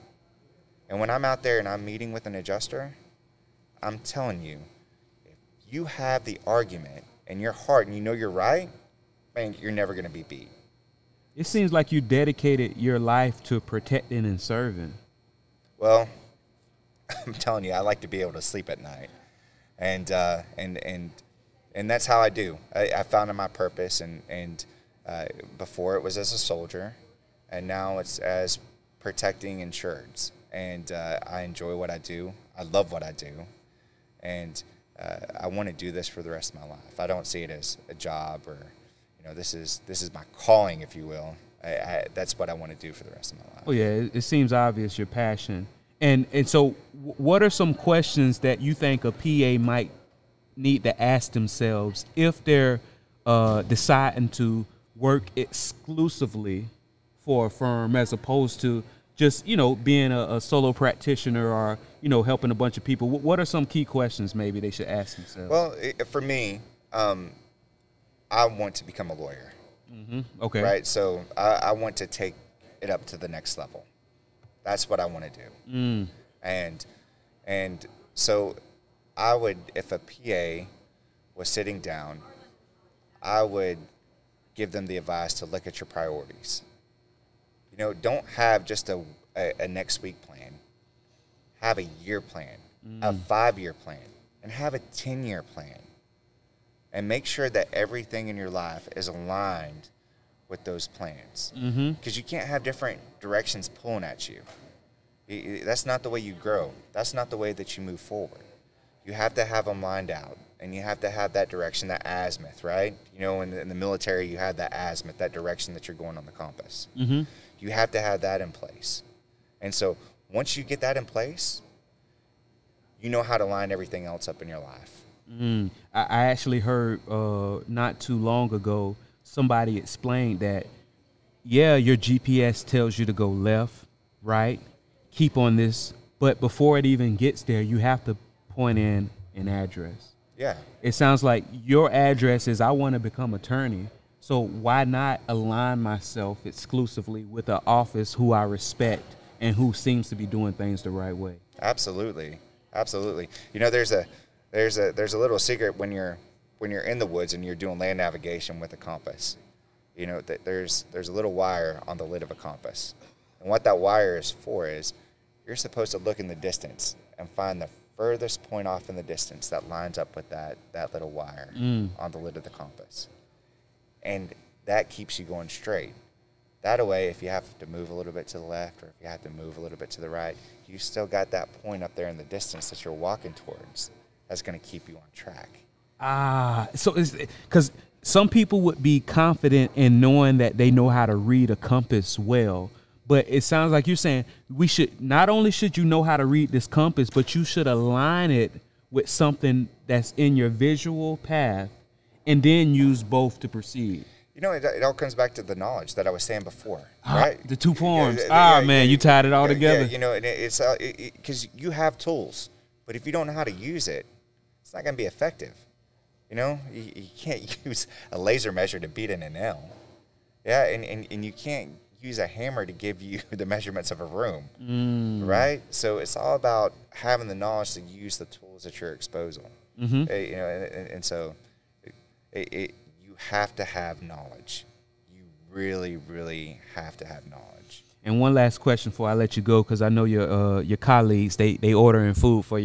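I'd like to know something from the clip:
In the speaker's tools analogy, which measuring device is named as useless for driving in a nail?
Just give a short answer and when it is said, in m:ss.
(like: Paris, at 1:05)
laser measure, at 3:38.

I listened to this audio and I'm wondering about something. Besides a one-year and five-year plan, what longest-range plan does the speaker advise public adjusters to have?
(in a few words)
10 year plan.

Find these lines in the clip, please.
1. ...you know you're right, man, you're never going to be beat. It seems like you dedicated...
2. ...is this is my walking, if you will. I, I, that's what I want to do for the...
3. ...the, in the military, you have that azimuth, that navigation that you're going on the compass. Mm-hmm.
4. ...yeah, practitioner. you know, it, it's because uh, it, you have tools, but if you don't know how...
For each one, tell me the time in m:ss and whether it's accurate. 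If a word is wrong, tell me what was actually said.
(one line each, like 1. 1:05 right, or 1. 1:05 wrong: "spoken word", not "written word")
1. 0:07 right
2. 0:39 wrong: "calling", not "walking"
3. 1:53 wrong: "direction", not "navigation"
4. 3:29 wrong: "together", not "practitioner".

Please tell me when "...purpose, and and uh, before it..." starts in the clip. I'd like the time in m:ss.
0:23.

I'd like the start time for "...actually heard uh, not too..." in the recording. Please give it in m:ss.
2:06.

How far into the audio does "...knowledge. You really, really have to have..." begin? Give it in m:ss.
3:54.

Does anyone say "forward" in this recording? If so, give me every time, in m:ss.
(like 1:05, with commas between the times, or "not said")
1:47.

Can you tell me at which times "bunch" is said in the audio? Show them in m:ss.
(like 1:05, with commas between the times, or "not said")
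1:02.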